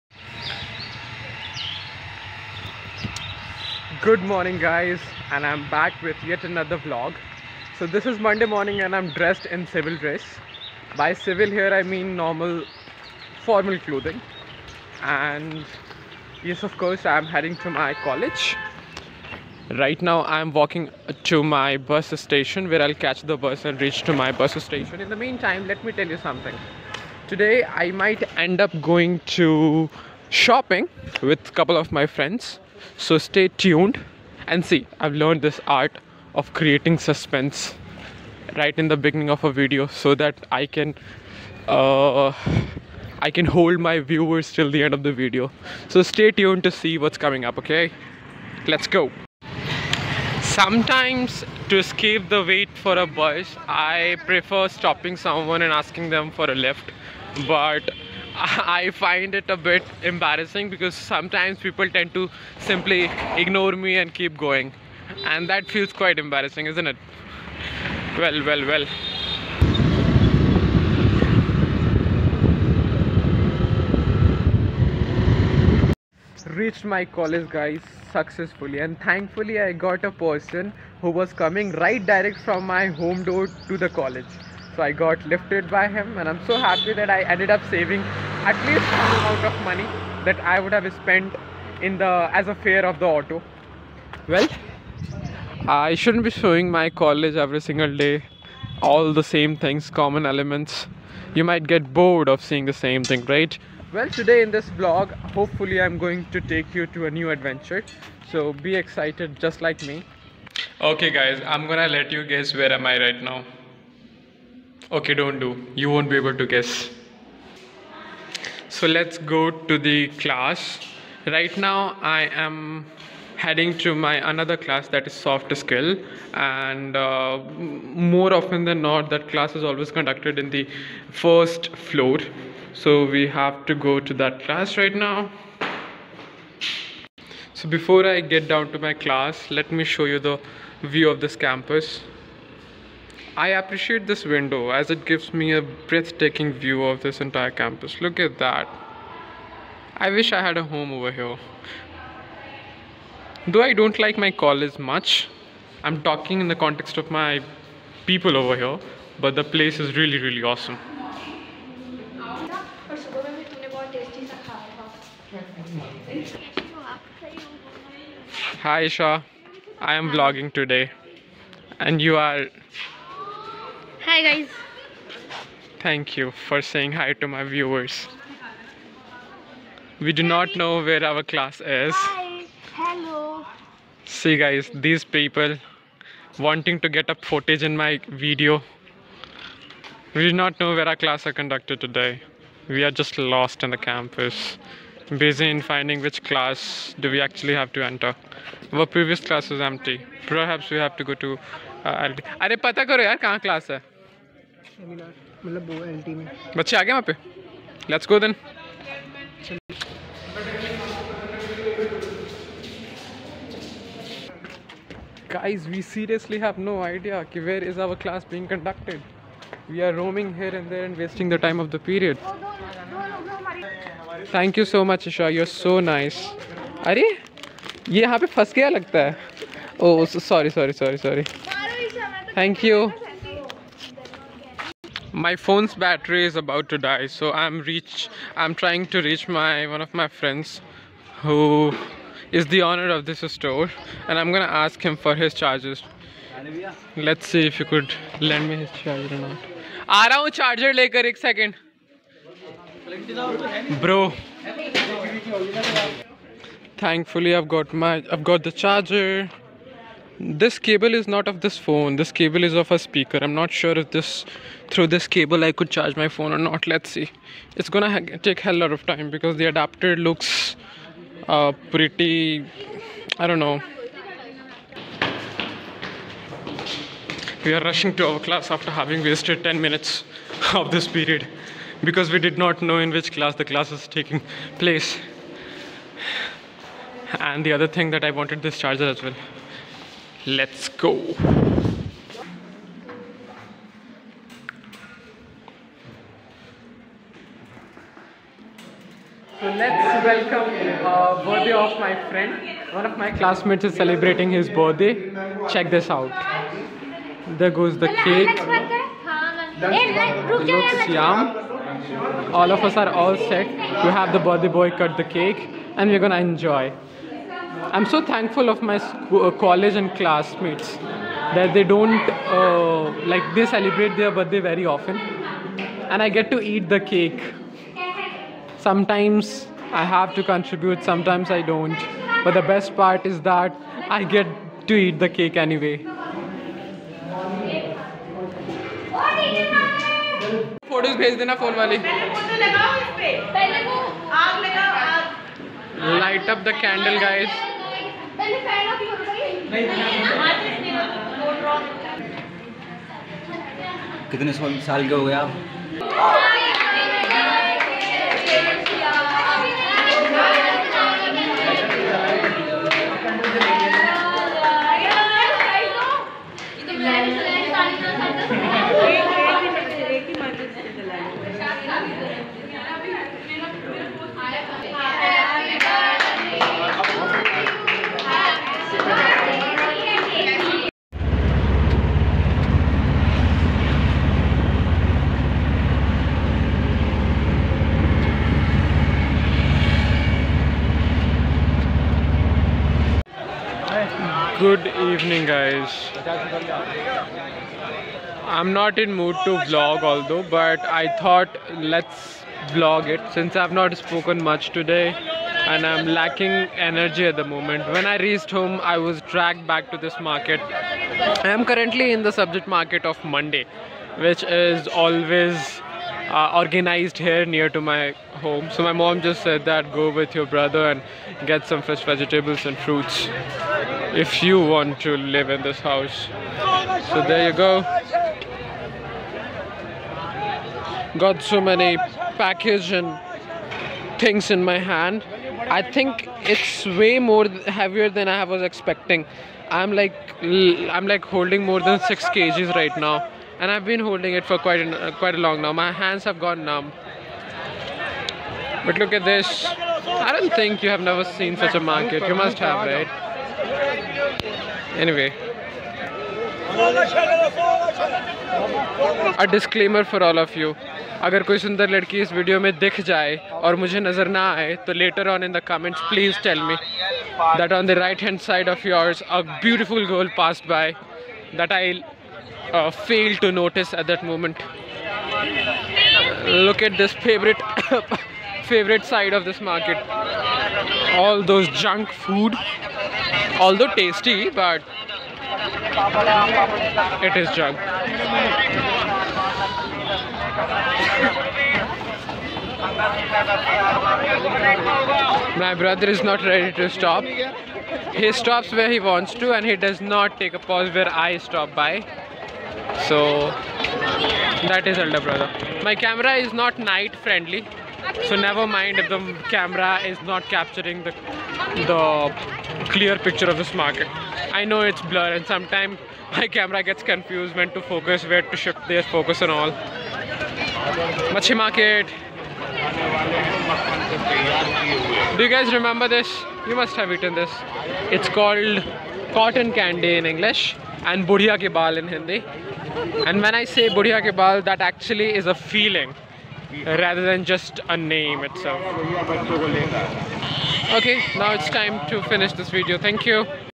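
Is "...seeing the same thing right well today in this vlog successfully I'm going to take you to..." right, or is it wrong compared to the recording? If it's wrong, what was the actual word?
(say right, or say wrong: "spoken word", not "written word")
wrong: "hopefully", not "successfully".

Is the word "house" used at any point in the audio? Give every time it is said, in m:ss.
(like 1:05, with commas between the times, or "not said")
7:05.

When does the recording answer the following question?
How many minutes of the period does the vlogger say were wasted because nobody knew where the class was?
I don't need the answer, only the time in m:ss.
4:39.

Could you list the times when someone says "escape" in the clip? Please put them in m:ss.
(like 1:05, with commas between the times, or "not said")
0:51.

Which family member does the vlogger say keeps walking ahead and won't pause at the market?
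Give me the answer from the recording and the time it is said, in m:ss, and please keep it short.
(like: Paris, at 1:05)
elder brother, at 8:24.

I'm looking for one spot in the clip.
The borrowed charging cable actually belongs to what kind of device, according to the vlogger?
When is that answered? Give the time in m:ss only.
4:22.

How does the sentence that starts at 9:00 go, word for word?
Okay, now it's time to finish this video.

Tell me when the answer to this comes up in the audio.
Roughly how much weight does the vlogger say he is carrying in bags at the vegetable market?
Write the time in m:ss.
7:21.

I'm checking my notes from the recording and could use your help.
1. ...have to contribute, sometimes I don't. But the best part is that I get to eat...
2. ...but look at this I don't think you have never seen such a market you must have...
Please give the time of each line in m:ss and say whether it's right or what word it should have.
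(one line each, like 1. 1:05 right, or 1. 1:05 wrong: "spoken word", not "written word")
1. 5:29 right
2. 7:28 right.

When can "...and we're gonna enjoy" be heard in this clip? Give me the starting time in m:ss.
5:15.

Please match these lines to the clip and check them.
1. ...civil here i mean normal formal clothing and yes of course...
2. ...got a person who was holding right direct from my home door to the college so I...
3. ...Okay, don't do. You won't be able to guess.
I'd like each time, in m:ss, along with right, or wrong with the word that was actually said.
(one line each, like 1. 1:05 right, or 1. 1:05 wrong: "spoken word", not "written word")
1. 0:11 right
2. 1:19 wrong: "coming", not "holding"
3. 1:54 right.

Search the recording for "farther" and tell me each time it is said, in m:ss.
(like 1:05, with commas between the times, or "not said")
not said.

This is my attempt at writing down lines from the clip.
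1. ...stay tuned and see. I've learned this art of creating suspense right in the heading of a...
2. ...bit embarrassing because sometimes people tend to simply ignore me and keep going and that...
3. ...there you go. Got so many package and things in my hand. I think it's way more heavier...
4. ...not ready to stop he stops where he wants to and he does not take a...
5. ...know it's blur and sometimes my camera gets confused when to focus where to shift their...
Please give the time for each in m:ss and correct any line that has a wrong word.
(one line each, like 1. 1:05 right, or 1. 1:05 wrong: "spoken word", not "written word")
1. 0:33 wrong: "beginning", not "heading"
2. 0:59 right
3. 7:07 right
4. 8:16 right
5. 8:34 right.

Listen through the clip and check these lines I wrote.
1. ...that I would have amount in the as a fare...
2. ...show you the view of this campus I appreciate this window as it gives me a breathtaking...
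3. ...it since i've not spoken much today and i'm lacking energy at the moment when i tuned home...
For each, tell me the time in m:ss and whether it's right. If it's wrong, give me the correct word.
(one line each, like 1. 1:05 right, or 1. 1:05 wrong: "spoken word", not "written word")
1. 1:30 wrong: "spent", not "amount"
2. 2:19 right
3. 6:42 wrong: "reached", not "tuned".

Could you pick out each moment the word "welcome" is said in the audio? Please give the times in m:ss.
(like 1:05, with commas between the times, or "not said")
5:00.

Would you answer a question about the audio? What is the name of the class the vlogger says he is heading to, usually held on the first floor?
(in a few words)
soft skill.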